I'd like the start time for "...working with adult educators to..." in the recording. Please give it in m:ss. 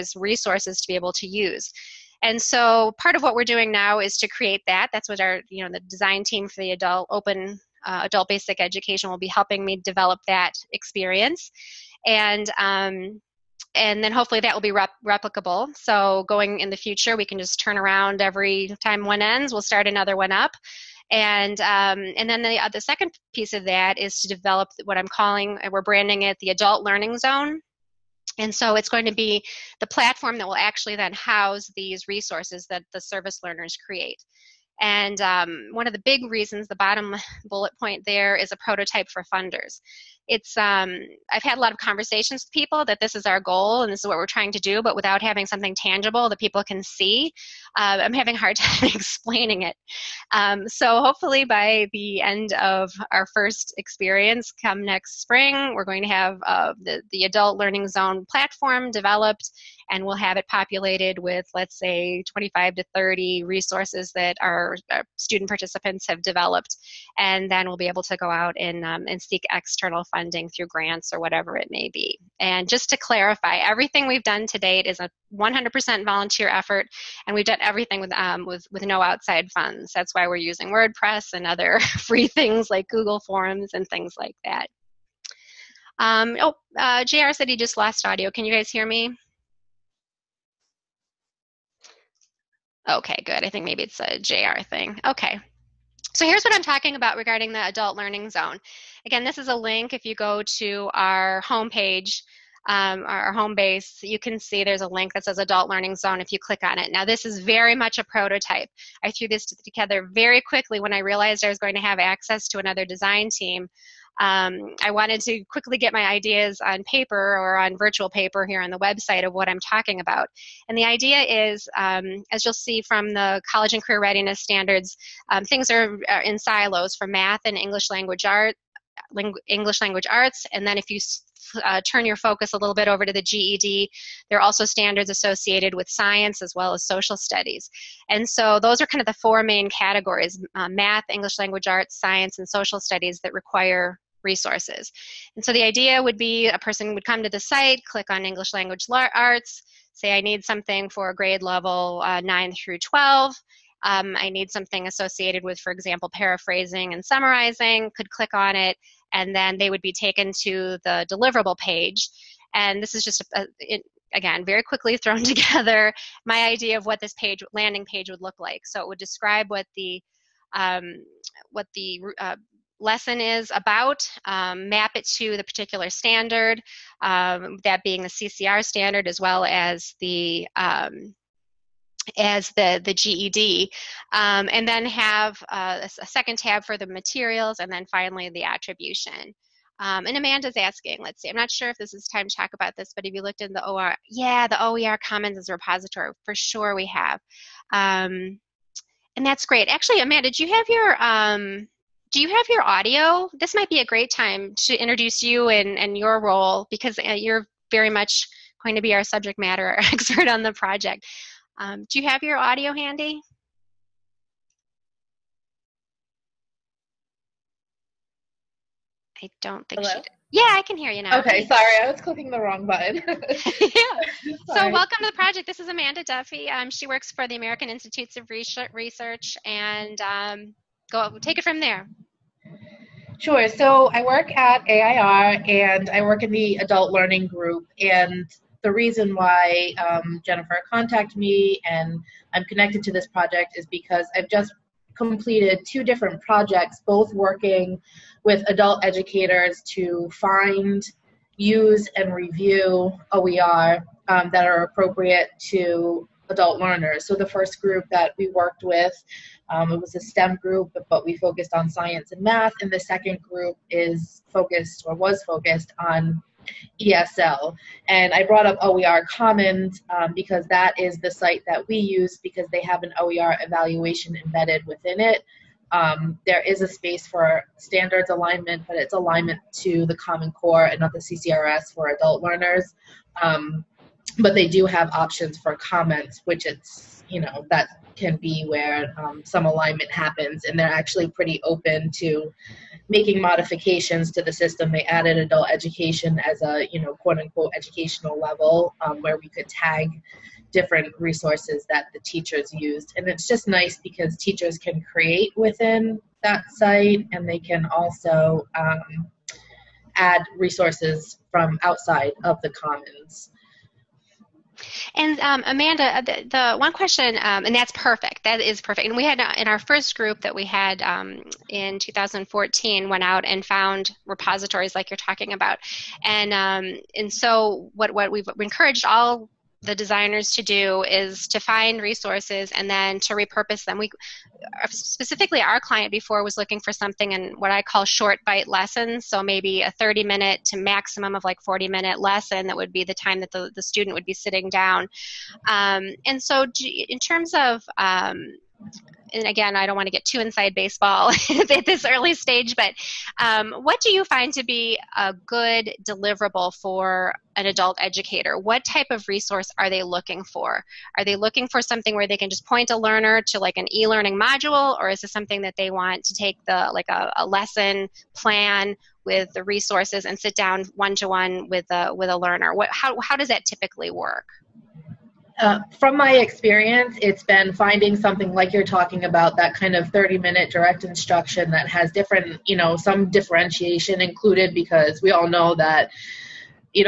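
4:07.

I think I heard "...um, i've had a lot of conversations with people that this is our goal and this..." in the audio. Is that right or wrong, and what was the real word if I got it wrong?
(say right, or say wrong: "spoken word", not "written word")
right.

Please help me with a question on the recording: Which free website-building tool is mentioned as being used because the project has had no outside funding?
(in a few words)
WordPress.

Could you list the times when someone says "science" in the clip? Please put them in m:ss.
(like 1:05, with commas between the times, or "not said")
2:15, 2:21, 4:21.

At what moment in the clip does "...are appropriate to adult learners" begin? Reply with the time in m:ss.
4:14.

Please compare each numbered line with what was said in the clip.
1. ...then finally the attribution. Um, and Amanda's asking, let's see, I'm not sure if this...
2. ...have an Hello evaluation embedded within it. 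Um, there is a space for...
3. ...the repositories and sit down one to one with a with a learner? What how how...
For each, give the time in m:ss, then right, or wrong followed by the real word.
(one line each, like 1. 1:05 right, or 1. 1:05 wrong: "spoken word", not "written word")
1. 3:07 right
2. 4:32 wrong: "OER", not "Hello"
3. 6:09 wrong: "resources", not "repositories".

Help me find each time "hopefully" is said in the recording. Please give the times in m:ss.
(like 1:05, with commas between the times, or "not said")
0:14, 0:51.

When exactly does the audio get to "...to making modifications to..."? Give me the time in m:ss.
4:51.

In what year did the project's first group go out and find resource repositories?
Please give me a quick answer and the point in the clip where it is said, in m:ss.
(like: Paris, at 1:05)
2014, at 5:21.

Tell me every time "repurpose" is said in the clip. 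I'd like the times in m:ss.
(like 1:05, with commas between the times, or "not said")
5:33.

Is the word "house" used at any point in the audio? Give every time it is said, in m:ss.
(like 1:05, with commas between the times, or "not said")
0:31.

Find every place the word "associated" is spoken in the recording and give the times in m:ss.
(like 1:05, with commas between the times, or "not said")
2:15, 2:34.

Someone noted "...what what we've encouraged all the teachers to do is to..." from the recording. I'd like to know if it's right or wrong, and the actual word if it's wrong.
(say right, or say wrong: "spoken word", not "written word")
wrong: "designers", not "teachers".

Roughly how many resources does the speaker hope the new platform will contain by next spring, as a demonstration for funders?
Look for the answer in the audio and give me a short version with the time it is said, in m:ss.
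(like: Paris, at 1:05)
25 to 30, at 1:02.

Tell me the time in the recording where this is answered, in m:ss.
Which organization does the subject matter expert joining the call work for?
3:47.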